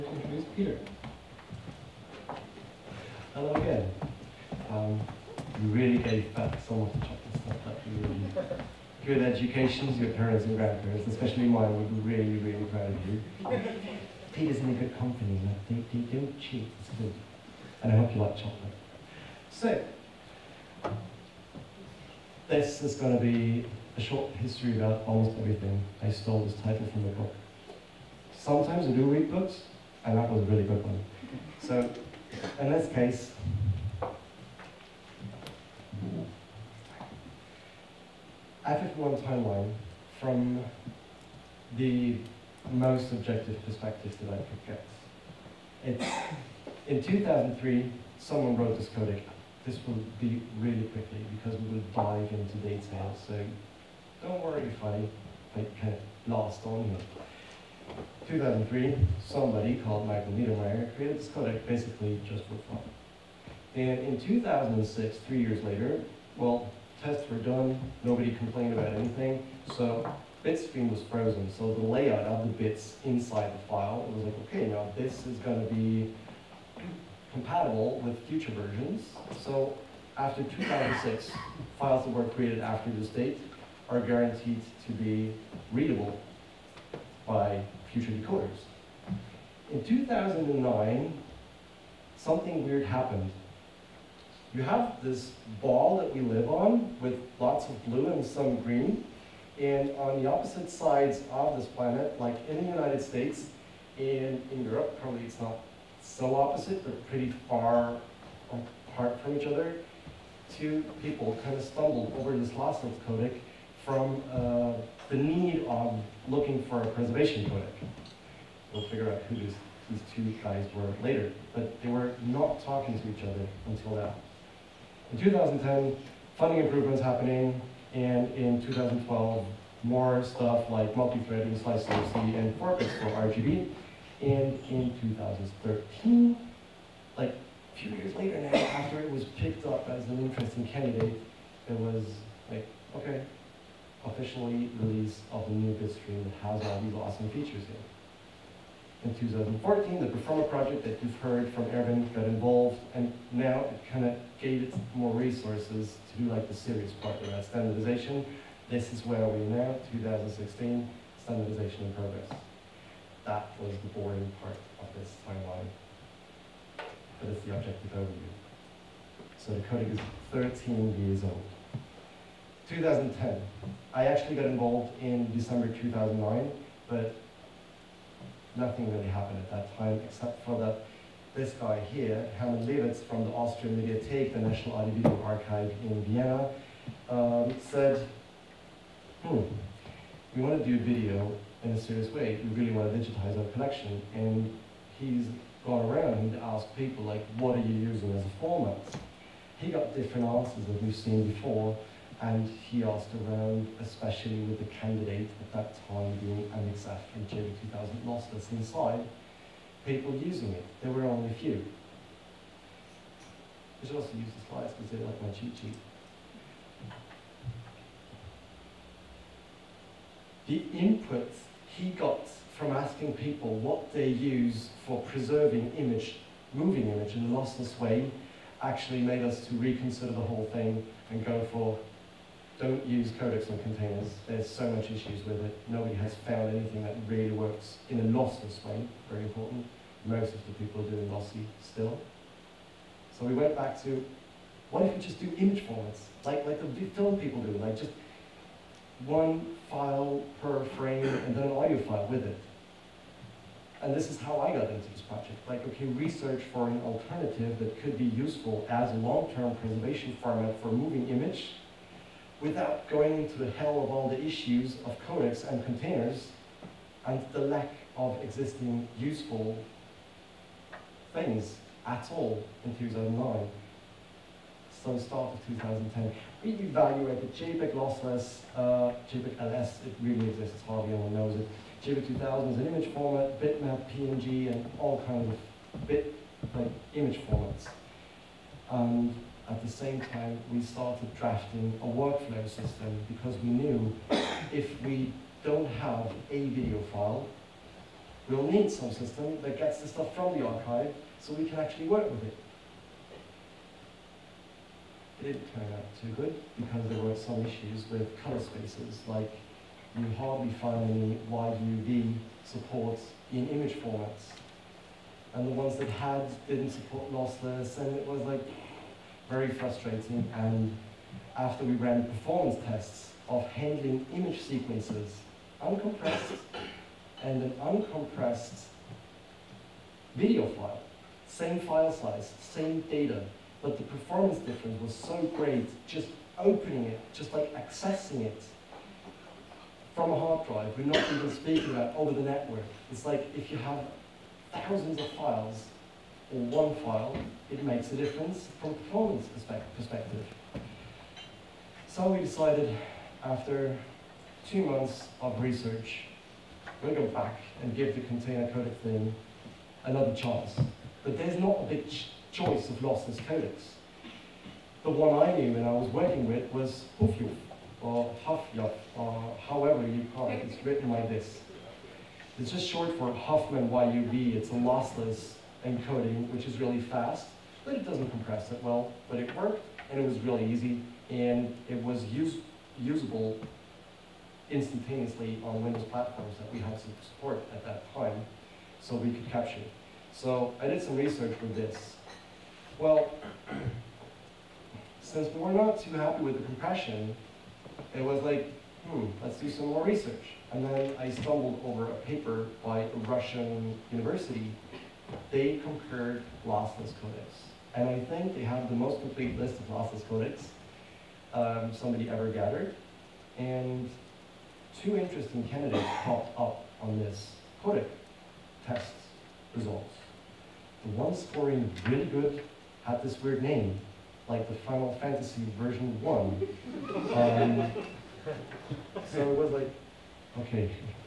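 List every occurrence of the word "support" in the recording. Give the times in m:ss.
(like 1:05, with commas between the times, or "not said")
5:12, 5:16, 6:27.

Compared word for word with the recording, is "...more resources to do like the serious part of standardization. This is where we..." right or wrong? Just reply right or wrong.
right.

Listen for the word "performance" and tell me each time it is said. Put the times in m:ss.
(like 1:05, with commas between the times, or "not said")
5:22, 5:33, 5:48.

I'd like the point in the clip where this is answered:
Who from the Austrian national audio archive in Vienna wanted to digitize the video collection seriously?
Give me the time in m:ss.
3:02.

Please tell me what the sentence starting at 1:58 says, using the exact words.
We'll figure out who these two guys were later, but they were not talking to each other until now.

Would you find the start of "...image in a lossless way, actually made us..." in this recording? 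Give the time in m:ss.
3:46.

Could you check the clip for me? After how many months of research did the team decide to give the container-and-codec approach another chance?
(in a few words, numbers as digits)
2.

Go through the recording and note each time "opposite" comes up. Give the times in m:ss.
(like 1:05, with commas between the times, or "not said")
1:40, 1:46.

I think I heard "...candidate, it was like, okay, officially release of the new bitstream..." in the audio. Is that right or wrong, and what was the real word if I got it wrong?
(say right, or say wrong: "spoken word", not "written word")
right.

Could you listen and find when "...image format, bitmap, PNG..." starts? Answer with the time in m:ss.
4:42.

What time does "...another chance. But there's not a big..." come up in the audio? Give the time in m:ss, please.
5:59.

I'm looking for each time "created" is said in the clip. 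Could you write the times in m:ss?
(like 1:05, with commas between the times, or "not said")
1:00, 1:22.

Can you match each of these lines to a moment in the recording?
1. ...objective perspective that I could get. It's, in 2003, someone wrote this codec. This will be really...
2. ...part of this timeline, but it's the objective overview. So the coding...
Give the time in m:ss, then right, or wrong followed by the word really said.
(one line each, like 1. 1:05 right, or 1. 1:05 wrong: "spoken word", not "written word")
1. 0:43 right
2. 2:44 right.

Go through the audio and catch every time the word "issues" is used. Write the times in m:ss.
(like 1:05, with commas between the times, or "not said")
3:54, 4:24, 5:07.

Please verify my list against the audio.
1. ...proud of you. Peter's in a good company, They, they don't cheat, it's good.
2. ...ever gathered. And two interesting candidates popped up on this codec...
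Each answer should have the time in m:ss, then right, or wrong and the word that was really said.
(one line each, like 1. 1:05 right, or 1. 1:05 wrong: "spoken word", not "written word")
1. 0:12 right
2. 6:52 right.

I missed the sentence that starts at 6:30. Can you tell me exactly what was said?
So I did some research for this.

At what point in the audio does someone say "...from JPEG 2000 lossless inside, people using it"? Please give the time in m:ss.
3:27.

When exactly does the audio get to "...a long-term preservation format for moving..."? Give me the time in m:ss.
4:18.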